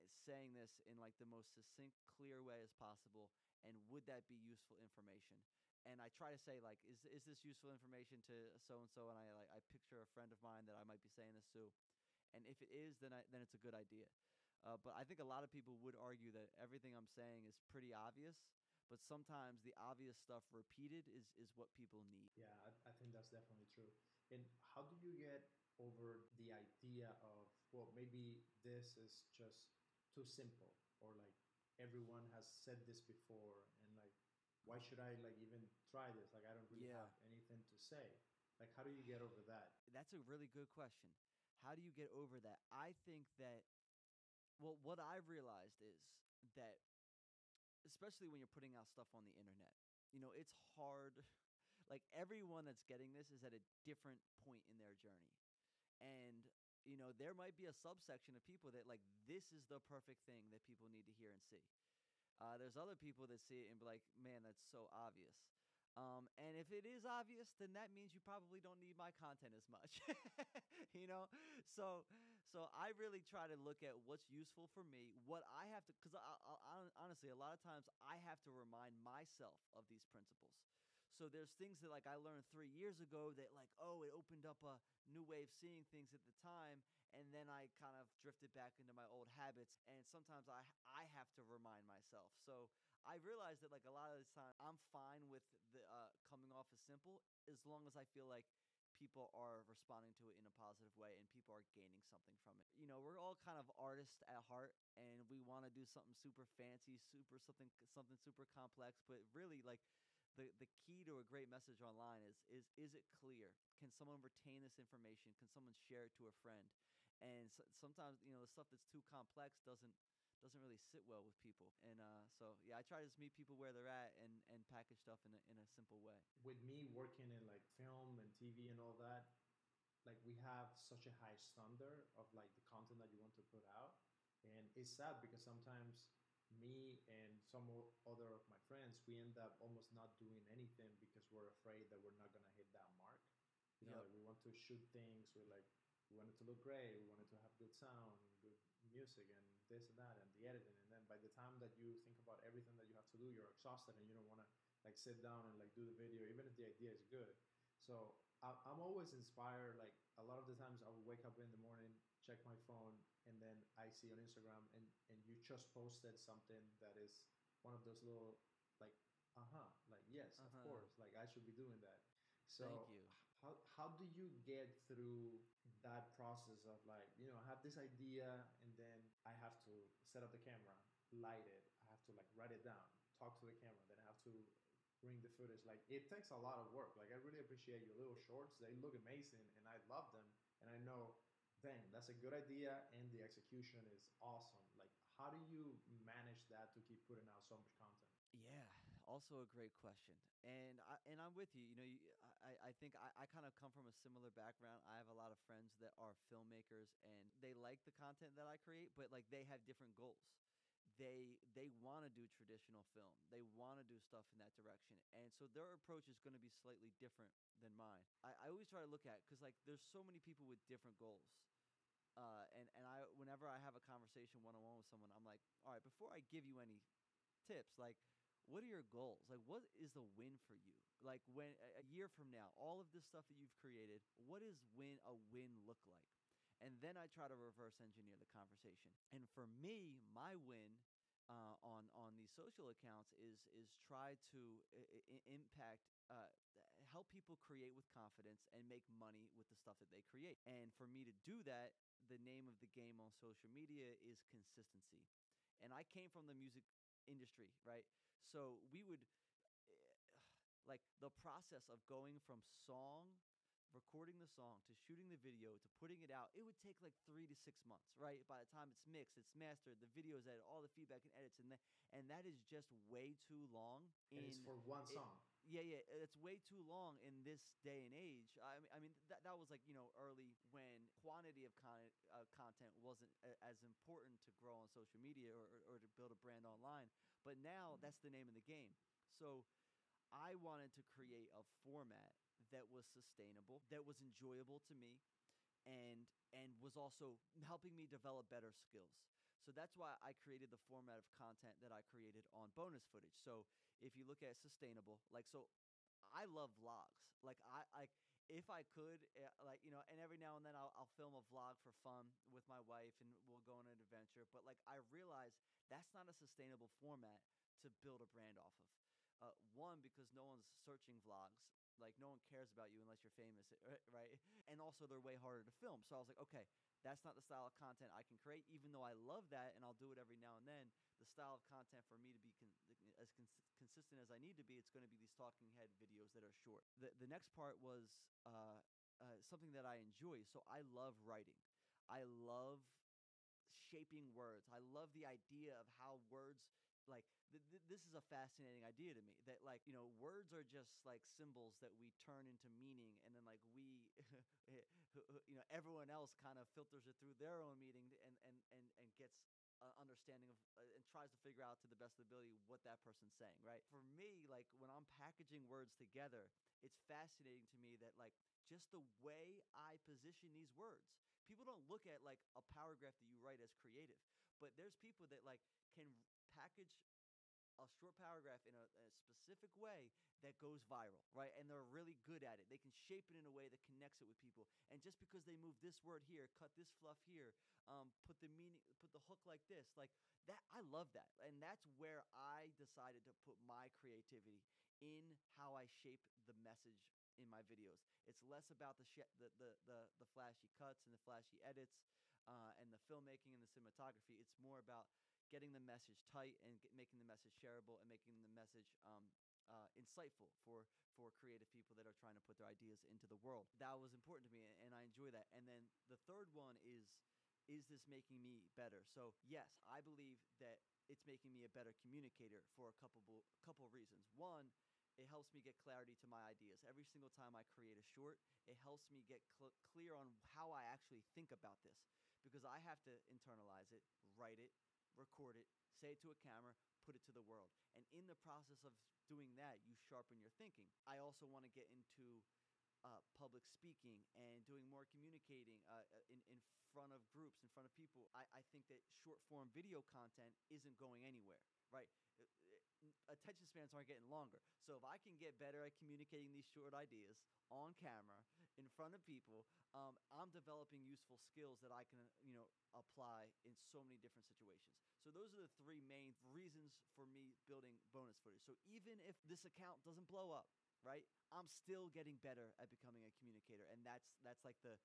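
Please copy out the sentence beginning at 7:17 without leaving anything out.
And in the process of doing that, you sharpen your thinking.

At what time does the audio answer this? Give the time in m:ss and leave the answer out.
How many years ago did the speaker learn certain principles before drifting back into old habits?
1:22.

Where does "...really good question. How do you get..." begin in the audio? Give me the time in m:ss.
0:40.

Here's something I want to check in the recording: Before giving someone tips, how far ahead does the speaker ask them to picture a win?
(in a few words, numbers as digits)
A year.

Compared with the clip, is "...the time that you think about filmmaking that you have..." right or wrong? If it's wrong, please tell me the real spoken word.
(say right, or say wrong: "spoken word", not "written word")
wrong: "everything", not "filmmaking".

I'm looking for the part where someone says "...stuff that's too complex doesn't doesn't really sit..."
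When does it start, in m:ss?
1:58.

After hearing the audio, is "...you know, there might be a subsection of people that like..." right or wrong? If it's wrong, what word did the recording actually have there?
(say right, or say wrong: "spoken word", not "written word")
right.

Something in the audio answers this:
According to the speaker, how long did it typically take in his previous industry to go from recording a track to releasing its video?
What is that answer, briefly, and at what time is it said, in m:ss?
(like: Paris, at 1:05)
3 to 6 months, at 4:27.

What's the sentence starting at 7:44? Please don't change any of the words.
So those are the three main reasons for me building bonus footage.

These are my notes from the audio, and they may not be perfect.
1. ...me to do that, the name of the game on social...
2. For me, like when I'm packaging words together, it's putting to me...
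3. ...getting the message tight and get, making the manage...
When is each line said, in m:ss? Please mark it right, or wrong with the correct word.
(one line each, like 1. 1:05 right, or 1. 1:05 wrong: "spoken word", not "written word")
1. 4:10 right
2. 6:03 wrong: "fascinating", not "putting"
3. 6:45 wrong: "message", not "manage".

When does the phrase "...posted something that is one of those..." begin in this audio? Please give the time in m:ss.
2:45.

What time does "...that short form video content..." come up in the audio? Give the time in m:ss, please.
7:28.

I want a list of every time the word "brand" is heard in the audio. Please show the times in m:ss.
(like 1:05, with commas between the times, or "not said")
4:46, 5:18.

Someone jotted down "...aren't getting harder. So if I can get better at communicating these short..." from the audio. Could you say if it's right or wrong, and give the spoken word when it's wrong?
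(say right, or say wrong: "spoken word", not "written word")
wrong: "longer", not "harder".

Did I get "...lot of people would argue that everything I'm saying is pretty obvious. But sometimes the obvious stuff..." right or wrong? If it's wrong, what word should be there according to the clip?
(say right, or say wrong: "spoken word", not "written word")
right.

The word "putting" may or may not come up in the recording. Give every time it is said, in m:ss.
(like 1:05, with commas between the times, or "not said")
0:48, 3:17, 4:25.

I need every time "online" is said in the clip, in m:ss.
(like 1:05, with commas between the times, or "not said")
1:51, 4:46.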